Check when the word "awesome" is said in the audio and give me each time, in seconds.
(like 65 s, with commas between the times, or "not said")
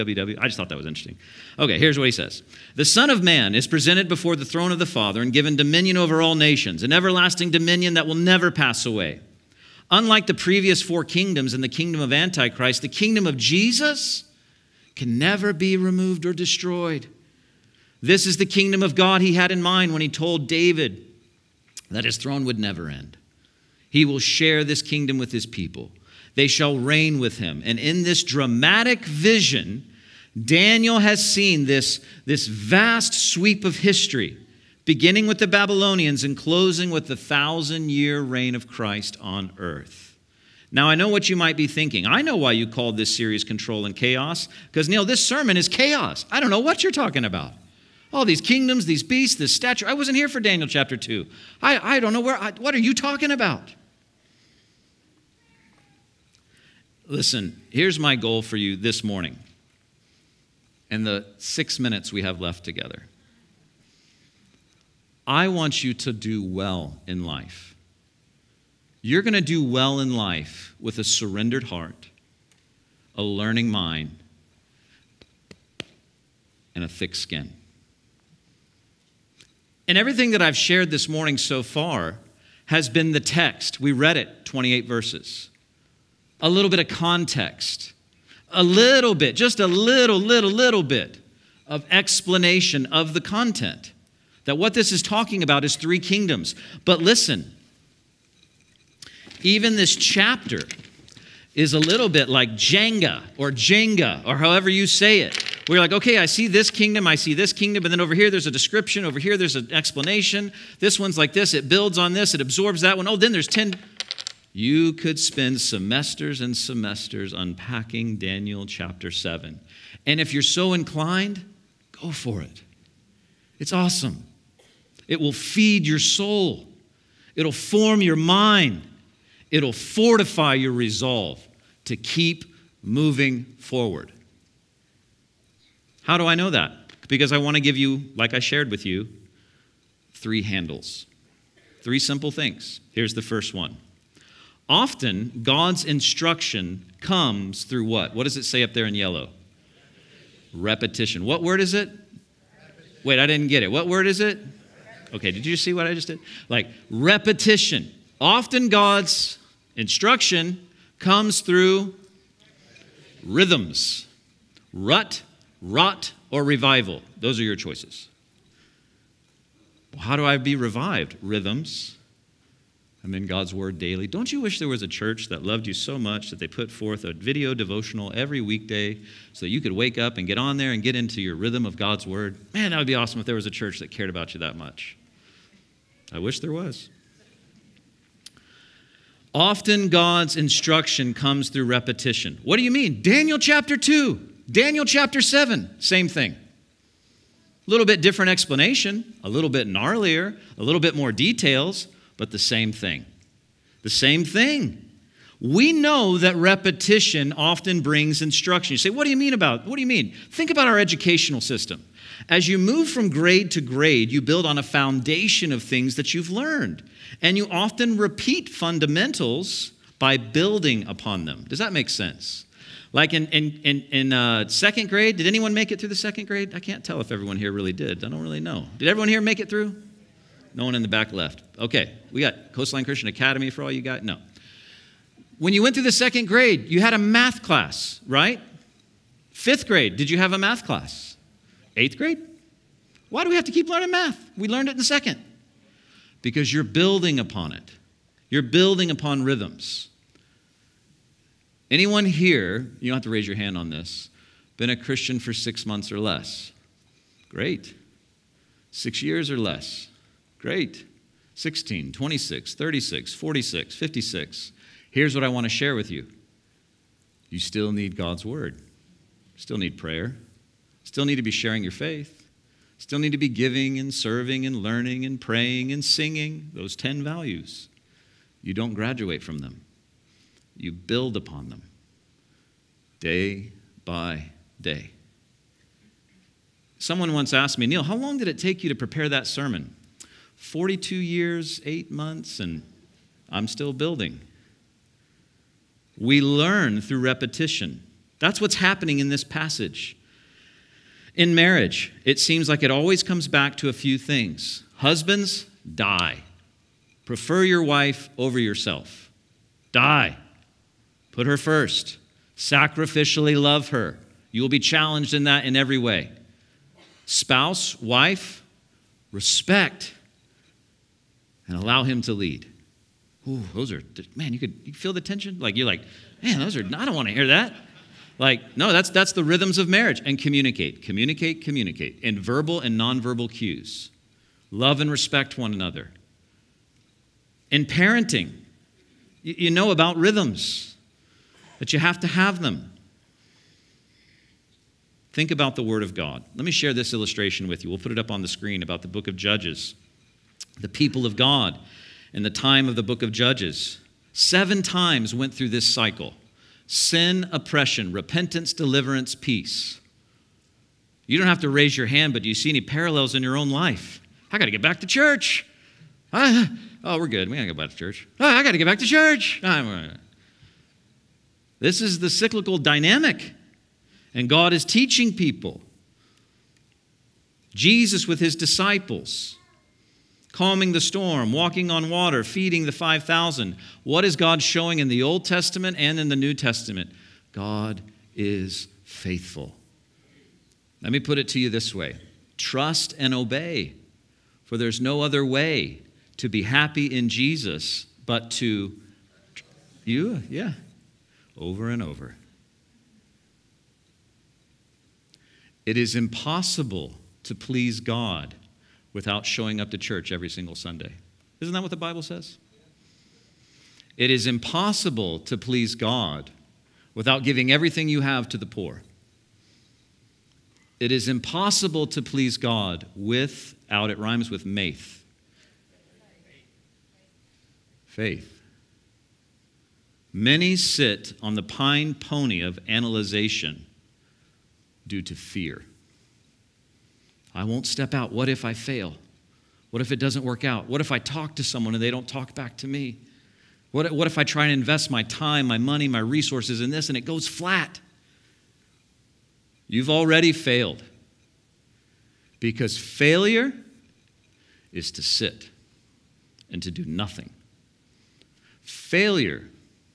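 123 s, 182 s.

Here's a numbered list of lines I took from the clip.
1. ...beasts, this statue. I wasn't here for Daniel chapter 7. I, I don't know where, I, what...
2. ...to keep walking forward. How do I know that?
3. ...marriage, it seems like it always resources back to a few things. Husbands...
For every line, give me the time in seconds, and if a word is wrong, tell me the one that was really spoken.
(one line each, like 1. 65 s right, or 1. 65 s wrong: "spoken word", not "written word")
1. 49 s wrong: "2", not "7"
2. 131 s wrong: "moving", not "walking"
3. 301 s wrong: "comes", not "resources".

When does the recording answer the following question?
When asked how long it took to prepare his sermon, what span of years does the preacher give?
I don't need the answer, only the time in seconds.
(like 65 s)
290 s.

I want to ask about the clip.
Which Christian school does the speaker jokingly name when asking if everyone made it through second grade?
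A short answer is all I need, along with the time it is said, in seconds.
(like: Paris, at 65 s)
Coastline Christian Academy, at 232 s.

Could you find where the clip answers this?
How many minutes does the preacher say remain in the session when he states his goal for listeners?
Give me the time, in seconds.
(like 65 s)
61 s.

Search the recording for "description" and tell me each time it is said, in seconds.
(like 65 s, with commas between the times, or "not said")
108 s.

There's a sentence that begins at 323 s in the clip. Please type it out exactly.
Ooh, those are, man, you could you feel the tension.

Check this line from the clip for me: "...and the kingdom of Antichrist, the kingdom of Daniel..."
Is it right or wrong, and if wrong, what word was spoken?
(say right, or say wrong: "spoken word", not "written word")
wrong: "Jesus", not "Daniel".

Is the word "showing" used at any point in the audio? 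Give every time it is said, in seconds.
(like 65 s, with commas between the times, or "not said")
384 s, 409 s.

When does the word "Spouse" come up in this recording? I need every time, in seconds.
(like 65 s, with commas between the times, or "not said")
317 s.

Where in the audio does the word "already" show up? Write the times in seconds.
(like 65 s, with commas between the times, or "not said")
449 s.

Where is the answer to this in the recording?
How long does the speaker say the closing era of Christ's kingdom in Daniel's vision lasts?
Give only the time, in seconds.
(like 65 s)
37 s.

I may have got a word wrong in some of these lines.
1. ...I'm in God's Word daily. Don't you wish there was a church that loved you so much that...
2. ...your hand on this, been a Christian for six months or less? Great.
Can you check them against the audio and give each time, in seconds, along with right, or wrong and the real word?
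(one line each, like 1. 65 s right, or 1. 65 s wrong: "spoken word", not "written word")
1. 173 s right
2. 253 s right.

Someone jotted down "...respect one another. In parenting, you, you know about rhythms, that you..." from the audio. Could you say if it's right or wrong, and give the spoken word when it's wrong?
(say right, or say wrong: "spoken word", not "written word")
right.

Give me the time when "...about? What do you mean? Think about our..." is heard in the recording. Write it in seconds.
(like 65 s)
209 s.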